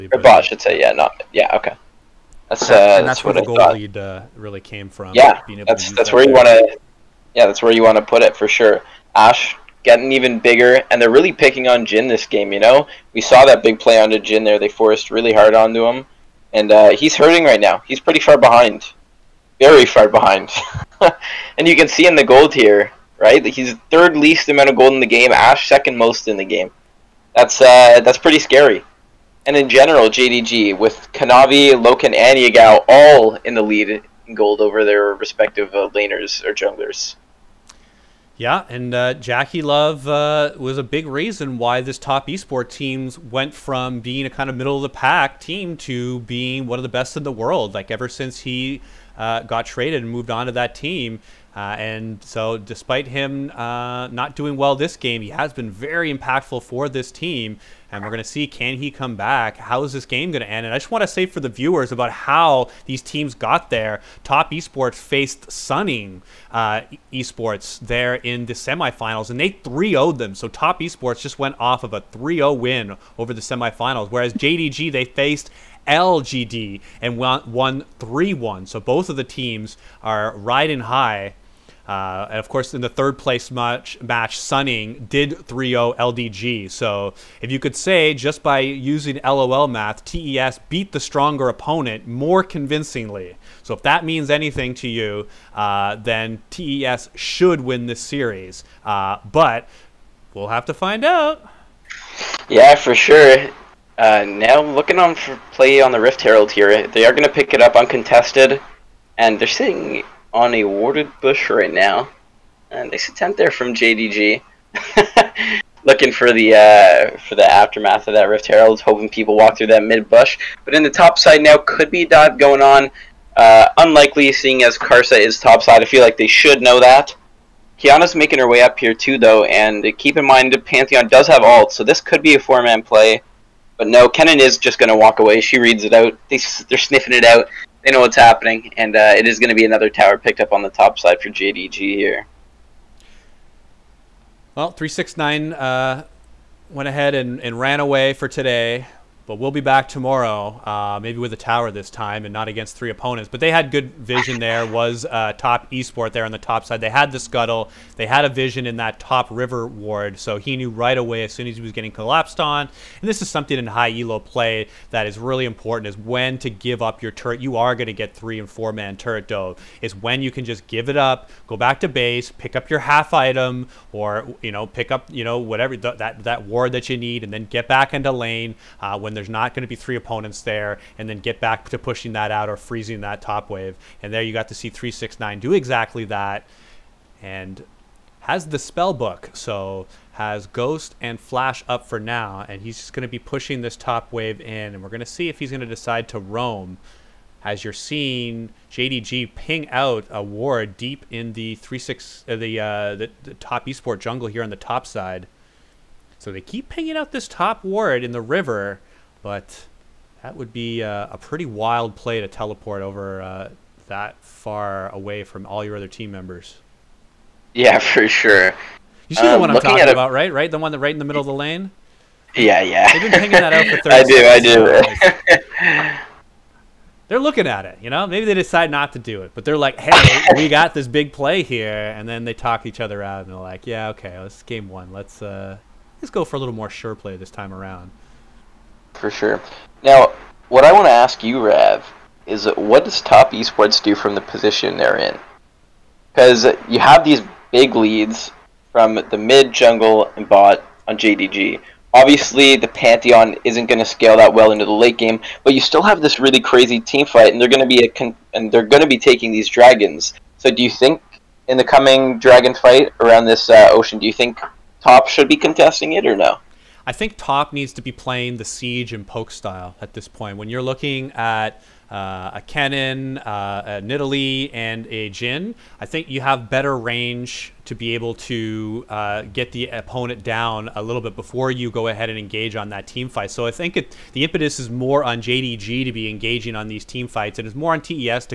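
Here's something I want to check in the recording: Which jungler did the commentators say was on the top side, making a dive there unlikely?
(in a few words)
Karsa.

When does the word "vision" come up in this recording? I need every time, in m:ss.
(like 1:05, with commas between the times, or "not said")
2:33, 2:38.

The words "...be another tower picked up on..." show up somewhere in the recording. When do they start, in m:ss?
2:19.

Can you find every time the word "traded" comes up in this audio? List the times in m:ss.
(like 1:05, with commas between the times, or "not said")
0:49.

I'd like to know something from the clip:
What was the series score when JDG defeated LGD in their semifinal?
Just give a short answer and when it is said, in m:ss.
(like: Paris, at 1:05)
3-1, at 1:17.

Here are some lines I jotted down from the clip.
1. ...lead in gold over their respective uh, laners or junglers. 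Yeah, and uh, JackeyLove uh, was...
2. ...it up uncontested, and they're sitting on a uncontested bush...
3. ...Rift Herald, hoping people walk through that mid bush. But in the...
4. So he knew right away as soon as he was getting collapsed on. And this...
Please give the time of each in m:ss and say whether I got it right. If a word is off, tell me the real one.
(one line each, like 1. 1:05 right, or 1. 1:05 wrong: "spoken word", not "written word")
1. 0:33 right
2. 1:47 wrong: "warded", not "uncontested"
3. 1:58 right
4. 2:40 right.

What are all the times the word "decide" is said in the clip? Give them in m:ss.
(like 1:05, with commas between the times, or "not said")
3:15, 3:48.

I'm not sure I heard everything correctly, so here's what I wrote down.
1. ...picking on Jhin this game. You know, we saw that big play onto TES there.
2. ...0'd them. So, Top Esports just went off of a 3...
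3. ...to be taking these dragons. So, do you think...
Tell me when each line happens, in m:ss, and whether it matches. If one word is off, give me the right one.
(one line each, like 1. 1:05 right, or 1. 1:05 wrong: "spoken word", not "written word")
1. 0:11 wrong: "Jhin", not "TES"
2. 1:09 right
3. 4:18 right.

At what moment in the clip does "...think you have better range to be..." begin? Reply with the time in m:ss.
4:35.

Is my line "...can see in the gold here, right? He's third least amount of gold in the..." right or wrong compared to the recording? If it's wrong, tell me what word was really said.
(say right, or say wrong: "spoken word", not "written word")
right.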